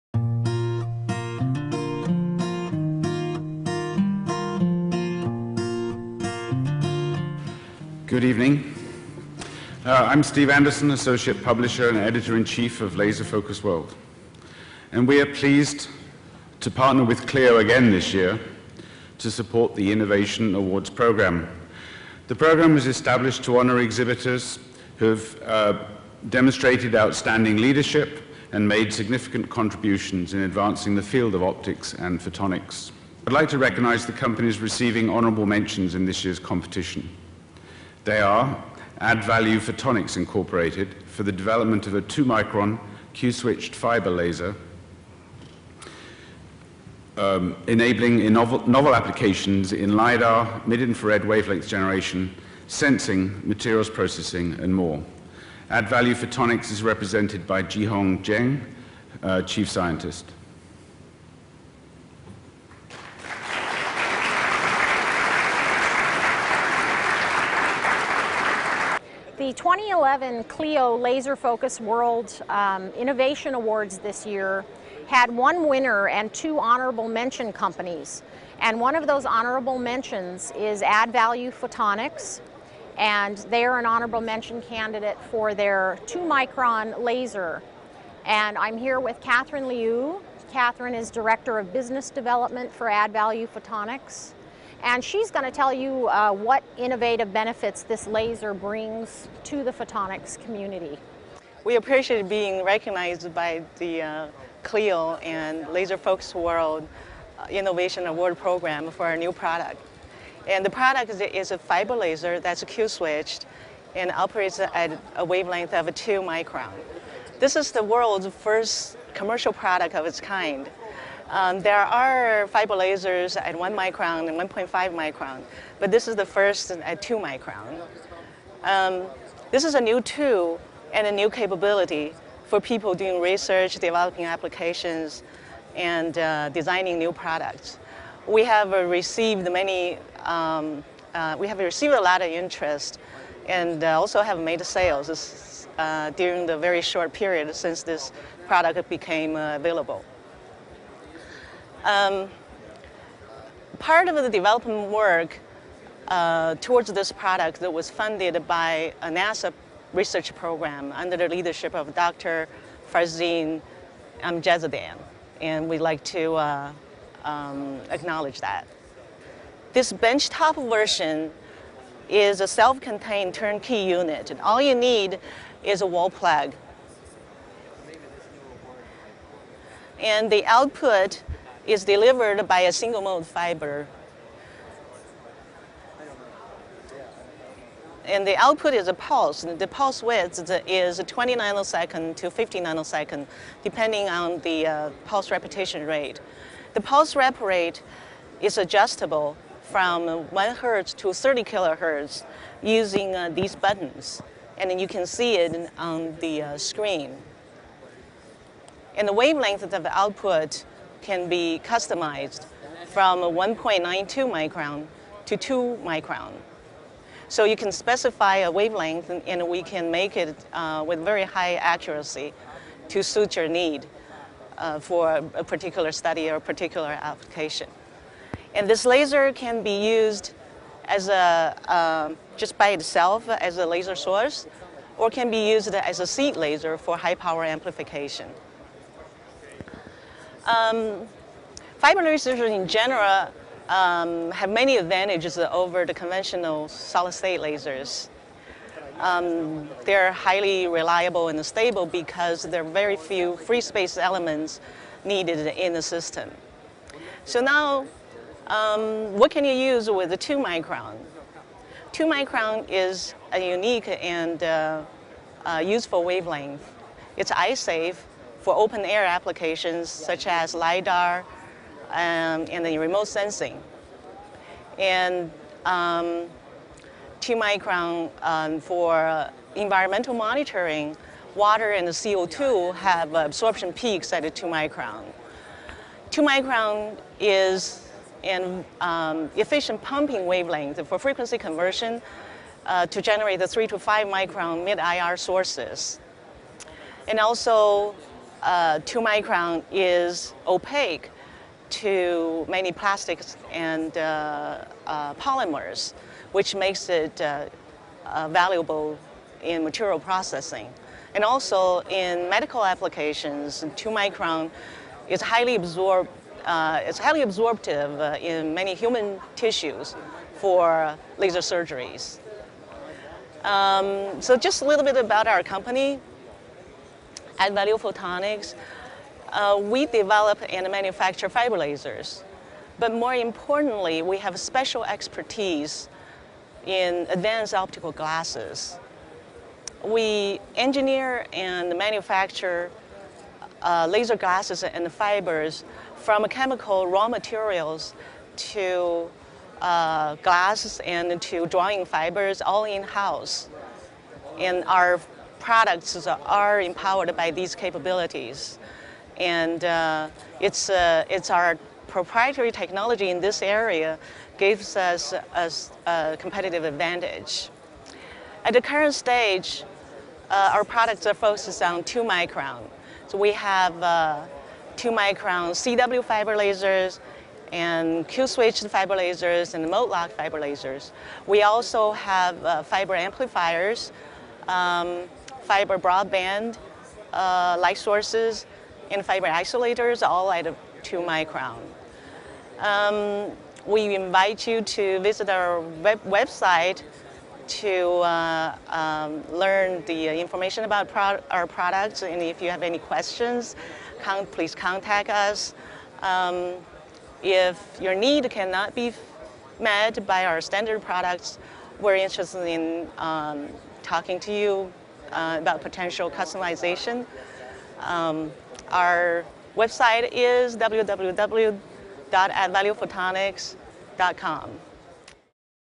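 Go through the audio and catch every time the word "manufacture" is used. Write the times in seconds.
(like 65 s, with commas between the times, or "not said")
330 s, 341 s.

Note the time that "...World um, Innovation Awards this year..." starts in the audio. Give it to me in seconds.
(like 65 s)
71 s.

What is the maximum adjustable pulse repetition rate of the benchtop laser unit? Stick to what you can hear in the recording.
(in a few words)
30 kilohertz.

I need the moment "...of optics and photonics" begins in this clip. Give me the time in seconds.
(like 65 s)
31 s.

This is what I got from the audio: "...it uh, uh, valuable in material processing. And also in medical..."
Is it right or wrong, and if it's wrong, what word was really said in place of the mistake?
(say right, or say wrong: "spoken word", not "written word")
right.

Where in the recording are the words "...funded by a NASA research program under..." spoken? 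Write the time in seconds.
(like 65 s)
157 s.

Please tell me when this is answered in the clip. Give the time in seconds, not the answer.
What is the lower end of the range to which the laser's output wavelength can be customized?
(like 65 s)
213 s.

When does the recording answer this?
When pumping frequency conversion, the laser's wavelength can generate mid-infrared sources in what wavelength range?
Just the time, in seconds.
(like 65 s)
293 s.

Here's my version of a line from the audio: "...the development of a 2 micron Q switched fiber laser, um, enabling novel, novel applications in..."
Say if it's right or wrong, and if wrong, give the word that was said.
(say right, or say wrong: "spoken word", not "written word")
right.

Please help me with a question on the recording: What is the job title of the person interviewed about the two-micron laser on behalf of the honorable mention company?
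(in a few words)
Director of Business Development.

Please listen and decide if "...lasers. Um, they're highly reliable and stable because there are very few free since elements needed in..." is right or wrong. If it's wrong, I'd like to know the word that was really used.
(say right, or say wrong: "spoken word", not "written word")
wrong: "space", not "since".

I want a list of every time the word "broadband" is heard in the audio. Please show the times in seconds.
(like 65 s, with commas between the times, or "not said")
385 s.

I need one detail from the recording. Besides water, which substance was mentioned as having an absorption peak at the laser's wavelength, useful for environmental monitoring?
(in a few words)
CO2.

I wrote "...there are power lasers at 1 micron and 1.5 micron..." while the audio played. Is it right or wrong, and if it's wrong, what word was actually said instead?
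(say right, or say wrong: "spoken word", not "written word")
wrong: "fiber", not "power".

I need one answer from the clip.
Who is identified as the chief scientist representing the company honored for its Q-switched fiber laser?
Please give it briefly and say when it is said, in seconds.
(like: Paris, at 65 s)
Jihong Zheng, at 57 s.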